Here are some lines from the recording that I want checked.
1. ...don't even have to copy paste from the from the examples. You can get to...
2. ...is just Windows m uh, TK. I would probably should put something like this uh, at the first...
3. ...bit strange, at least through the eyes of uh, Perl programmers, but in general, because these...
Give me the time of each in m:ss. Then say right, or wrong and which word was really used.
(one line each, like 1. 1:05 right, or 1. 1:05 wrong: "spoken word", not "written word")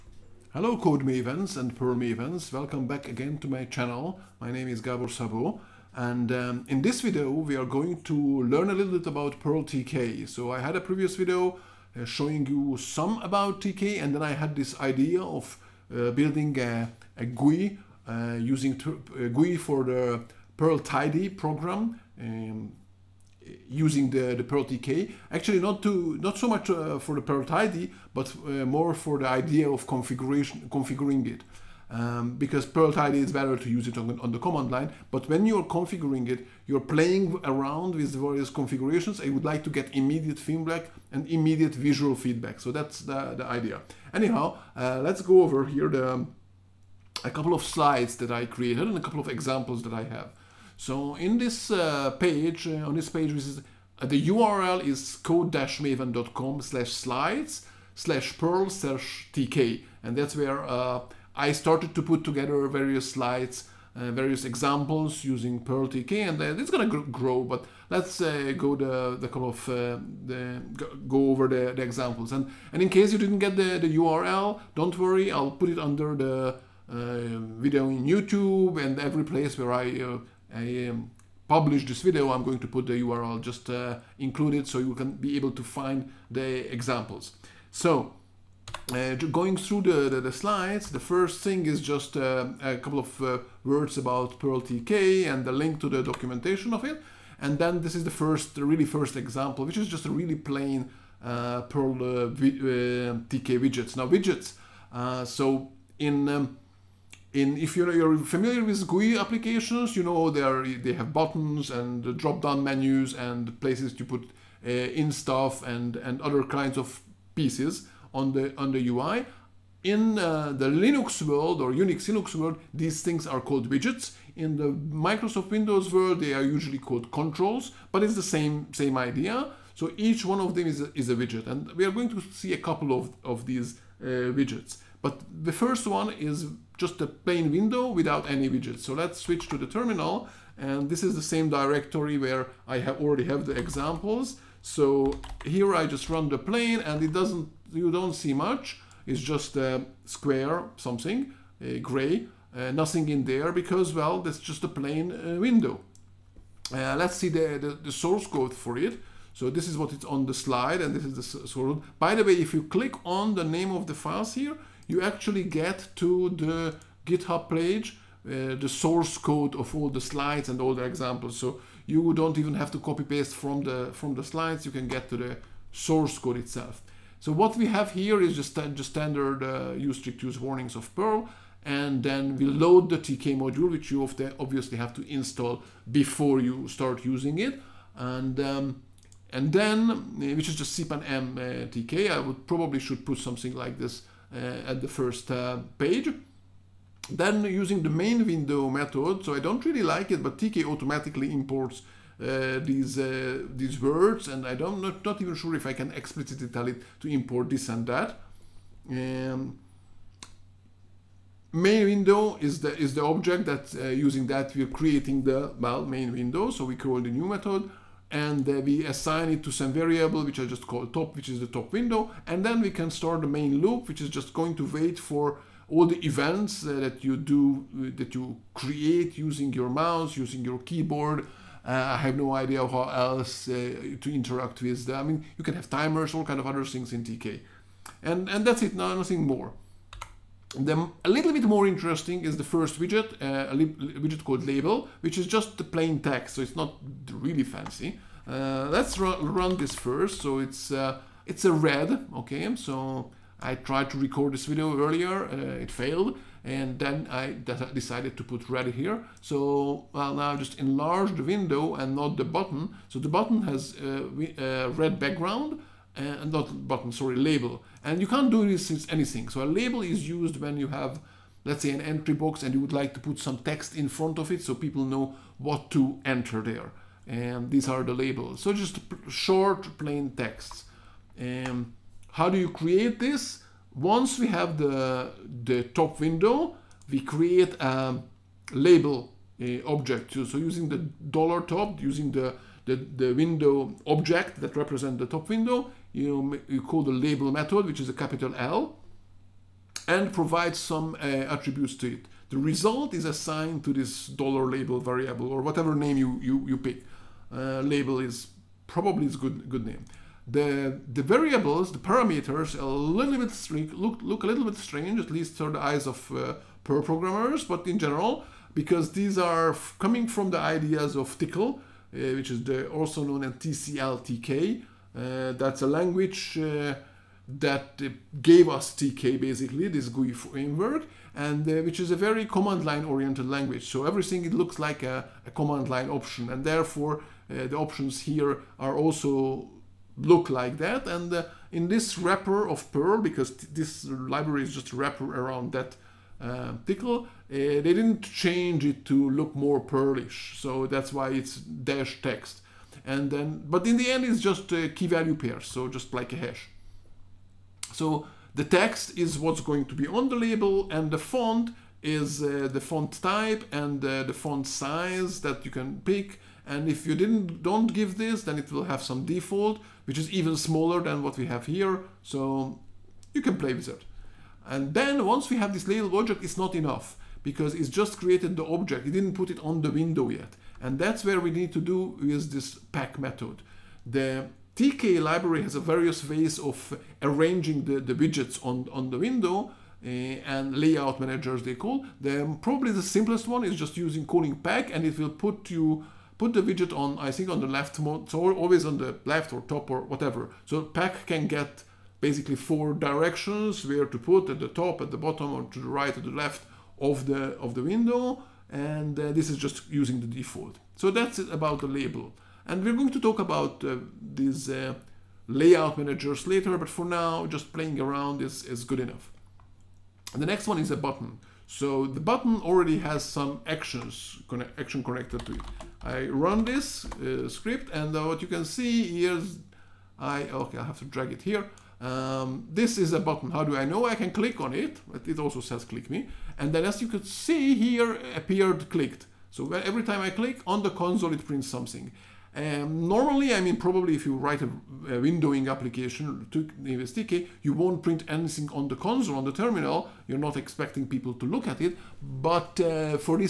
1. 2:52 wrong: "slides", not "examples"
2. 3:10 wrong: "CPAN", not "Windows"
3. 5:14 right.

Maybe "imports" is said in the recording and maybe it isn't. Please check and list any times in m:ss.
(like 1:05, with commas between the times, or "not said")
3:21, 3:27.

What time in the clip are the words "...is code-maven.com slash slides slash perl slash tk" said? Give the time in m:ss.
0:54.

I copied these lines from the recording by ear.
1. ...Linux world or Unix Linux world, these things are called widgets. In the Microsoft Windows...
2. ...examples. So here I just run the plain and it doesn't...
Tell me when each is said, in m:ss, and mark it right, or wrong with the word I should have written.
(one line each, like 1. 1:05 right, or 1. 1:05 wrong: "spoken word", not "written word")
1. 2:00 right
2. 2:23 right.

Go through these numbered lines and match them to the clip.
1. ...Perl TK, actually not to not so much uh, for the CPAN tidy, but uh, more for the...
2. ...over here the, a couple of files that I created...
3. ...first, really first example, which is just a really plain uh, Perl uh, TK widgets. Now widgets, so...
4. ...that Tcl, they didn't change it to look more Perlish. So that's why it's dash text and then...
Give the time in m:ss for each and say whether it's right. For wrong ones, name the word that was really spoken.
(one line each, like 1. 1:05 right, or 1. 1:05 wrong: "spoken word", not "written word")
1. 0:24 wrong: "Perl", not "CPAN"
2. 0:45 wrong: "slides", not "files"
3. 1:38 right
4. 5:45 right.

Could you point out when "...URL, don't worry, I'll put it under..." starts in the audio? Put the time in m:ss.
1:13.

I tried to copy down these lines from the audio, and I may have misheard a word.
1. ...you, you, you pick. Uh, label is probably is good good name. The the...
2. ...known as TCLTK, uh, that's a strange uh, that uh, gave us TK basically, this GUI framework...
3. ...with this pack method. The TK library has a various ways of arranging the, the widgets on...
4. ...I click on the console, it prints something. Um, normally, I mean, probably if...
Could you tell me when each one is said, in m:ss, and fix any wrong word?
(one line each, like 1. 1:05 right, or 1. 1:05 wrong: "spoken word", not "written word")
1. 5:05 right
2. 5:23 wrong: "language", not "strange"
3. 6:22 right
4. 7:19 right.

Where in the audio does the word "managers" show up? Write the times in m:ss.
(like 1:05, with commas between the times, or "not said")
6:31, 6:55.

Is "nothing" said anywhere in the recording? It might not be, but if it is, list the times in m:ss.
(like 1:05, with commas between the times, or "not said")
2:32, 3:58.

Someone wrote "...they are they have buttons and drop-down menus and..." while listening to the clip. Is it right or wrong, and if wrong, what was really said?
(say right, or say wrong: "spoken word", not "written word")
right.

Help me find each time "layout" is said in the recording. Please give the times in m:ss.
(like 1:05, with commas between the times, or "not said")
6:30, 6:55.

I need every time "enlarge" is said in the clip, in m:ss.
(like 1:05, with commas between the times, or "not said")
4:20.